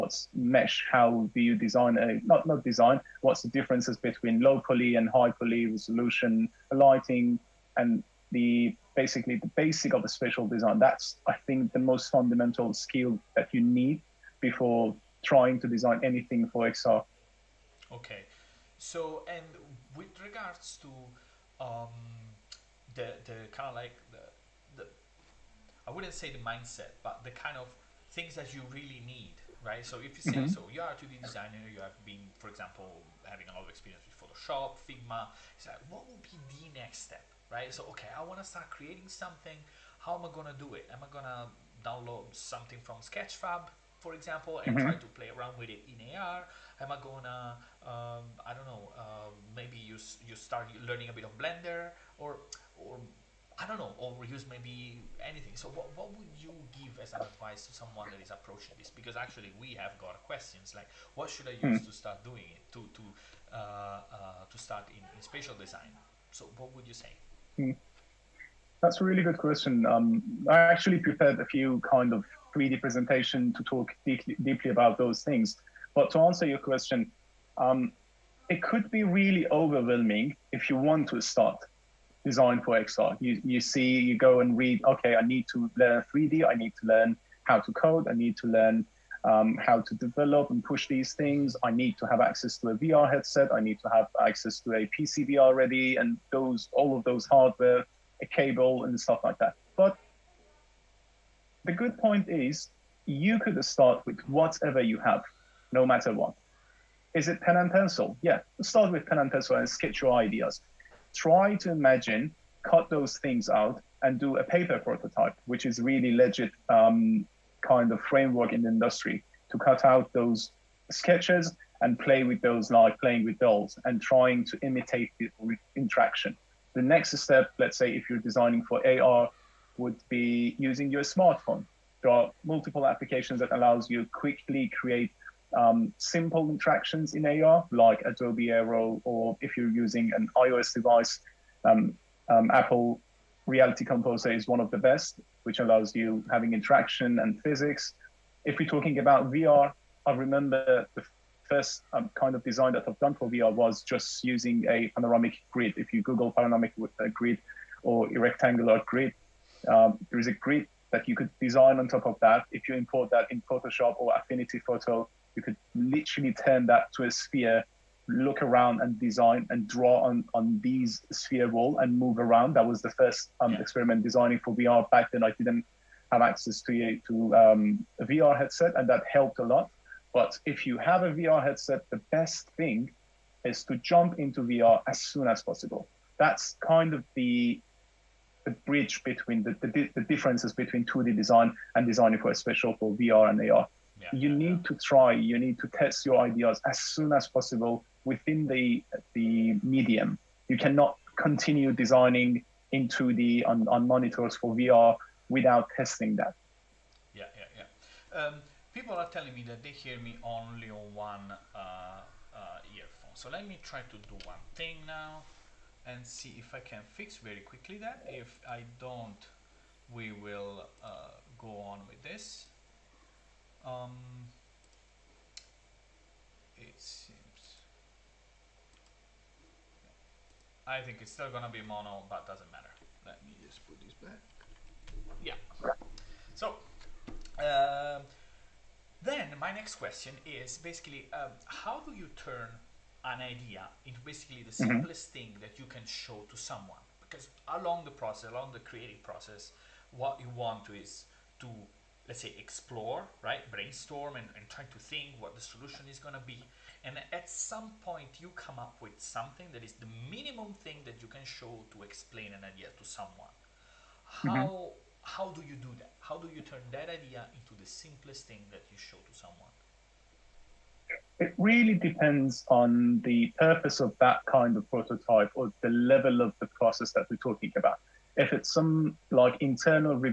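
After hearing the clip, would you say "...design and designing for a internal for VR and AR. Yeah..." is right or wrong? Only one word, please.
wrong.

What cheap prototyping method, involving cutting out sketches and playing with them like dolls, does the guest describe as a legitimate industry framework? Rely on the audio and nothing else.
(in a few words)
Paper prototype.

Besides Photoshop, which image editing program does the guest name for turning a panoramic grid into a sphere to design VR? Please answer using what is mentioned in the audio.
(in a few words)
Affinity Photo.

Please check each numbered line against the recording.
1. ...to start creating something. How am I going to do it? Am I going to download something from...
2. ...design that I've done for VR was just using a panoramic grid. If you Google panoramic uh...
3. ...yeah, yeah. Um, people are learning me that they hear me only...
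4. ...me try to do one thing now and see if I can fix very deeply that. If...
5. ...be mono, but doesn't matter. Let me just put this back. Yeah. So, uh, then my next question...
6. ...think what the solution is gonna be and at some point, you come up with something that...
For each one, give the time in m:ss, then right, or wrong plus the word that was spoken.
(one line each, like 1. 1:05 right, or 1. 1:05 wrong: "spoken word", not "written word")
1. 0:38 right
2. 2:32 right
3. 3:27 wrong: "telling", not "learning"
4. 3:33 wrong: "quickly", not "deeply"
5. 3:51 right
6. 4:14 right.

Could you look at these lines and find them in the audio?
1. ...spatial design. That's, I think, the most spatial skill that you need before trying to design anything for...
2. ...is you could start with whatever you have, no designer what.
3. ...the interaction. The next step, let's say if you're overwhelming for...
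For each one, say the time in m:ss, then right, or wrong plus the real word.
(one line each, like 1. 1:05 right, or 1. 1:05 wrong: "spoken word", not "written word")
1. 0:10 wrong: "fundamental", not "spatial"
2. 1:42 wrong: "matter", not "designer"
3. 2:05 wrong: "designing", not "overwhelming".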